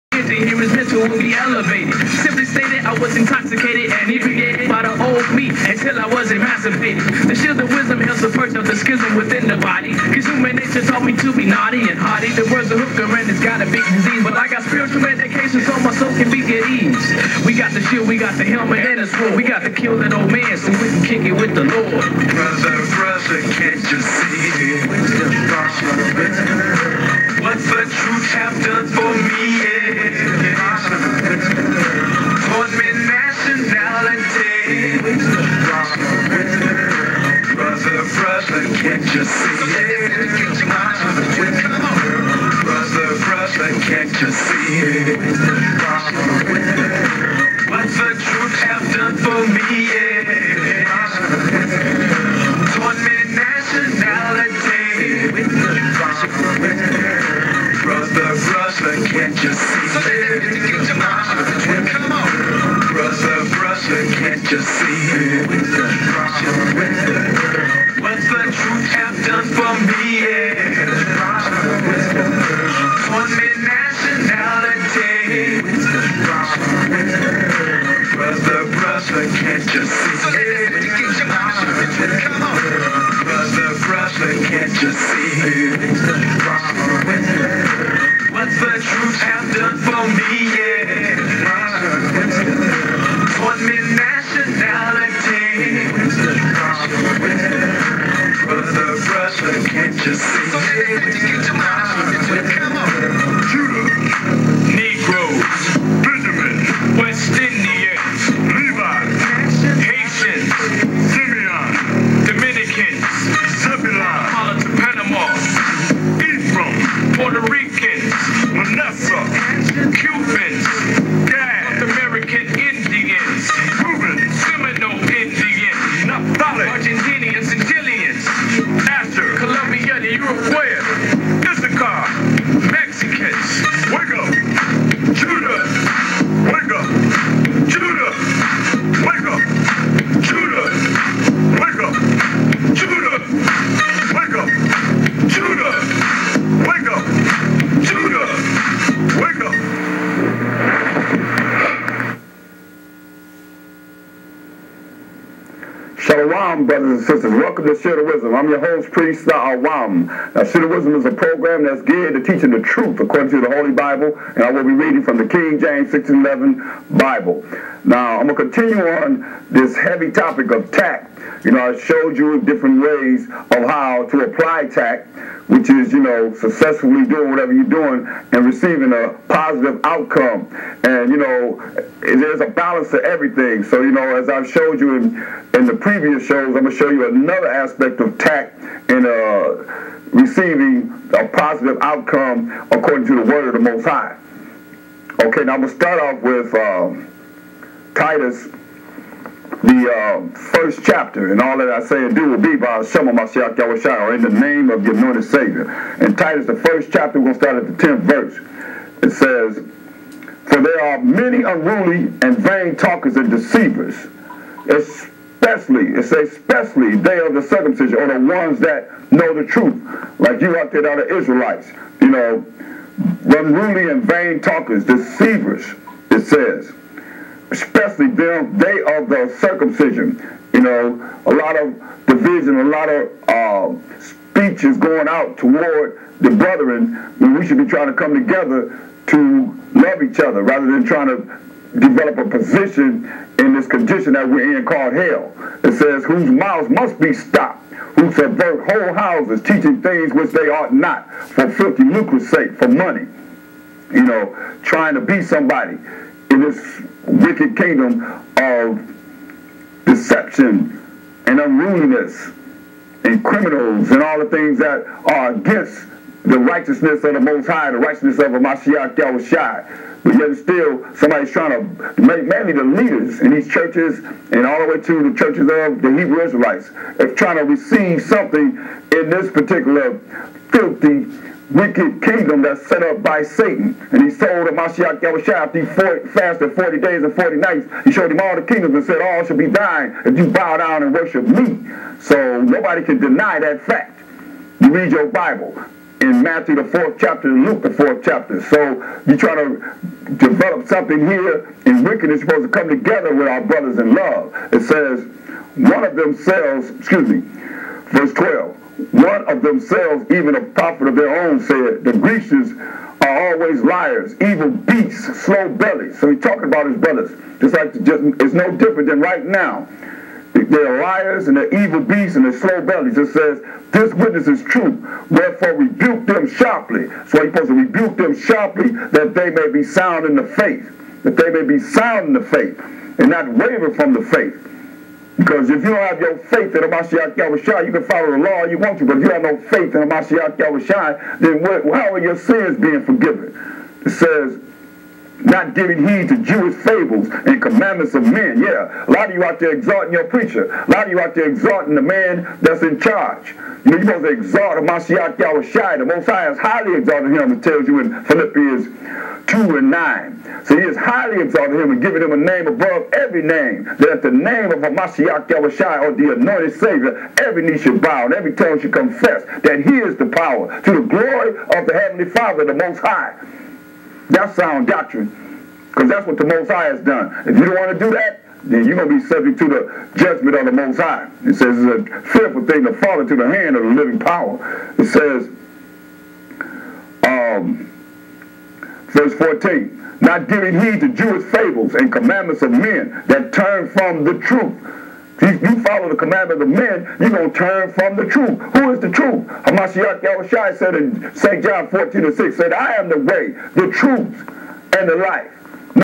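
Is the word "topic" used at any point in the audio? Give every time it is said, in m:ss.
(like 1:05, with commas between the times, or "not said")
2:50.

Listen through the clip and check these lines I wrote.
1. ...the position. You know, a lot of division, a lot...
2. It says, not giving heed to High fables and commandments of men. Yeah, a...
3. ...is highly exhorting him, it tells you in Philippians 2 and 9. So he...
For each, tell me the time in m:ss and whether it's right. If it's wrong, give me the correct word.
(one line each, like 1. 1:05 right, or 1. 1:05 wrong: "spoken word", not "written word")
1. 3:49 wrong: "circumcision", not "position"
2. 5:43 wrong: "Jewish", not "High"
3. 5:56 right.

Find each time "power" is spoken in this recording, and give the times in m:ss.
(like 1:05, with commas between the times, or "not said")
6:10, 6:23.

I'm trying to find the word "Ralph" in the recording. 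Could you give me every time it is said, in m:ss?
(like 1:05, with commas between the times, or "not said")
not said.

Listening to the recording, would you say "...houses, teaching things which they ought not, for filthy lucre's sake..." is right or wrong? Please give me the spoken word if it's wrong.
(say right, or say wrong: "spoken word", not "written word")
right.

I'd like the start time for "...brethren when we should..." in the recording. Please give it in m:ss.
3:56.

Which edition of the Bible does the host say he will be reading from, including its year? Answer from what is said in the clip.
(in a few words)
King James 1611.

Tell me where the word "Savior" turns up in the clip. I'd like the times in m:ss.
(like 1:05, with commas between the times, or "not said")
3:25, 6:06.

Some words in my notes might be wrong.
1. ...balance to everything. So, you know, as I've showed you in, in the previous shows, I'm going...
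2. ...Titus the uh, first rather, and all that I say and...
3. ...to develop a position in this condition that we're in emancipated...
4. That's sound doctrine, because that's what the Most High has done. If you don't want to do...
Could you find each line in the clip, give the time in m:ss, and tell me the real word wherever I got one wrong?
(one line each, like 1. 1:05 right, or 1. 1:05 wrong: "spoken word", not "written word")
1. 3:02 right
2. 3:17 wrong: "chapter", not "rather"
3. 4:01 wrong: "called", not "emancipated"
4. 6:14 right.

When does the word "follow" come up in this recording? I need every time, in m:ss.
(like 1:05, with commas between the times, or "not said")
5:37, 6:35.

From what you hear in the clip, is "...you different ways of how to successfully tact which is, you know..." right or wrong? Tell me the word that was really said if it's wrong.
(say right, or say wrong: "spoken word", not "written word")
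wrong: "apply", not "successfully".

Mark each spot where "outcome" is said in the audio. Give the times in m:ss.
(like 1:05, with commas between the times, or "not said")
2:59, 3:11.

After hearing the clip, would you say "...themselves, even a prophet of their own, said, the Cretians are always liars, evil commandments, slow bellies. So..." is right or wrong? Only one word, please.
wrong.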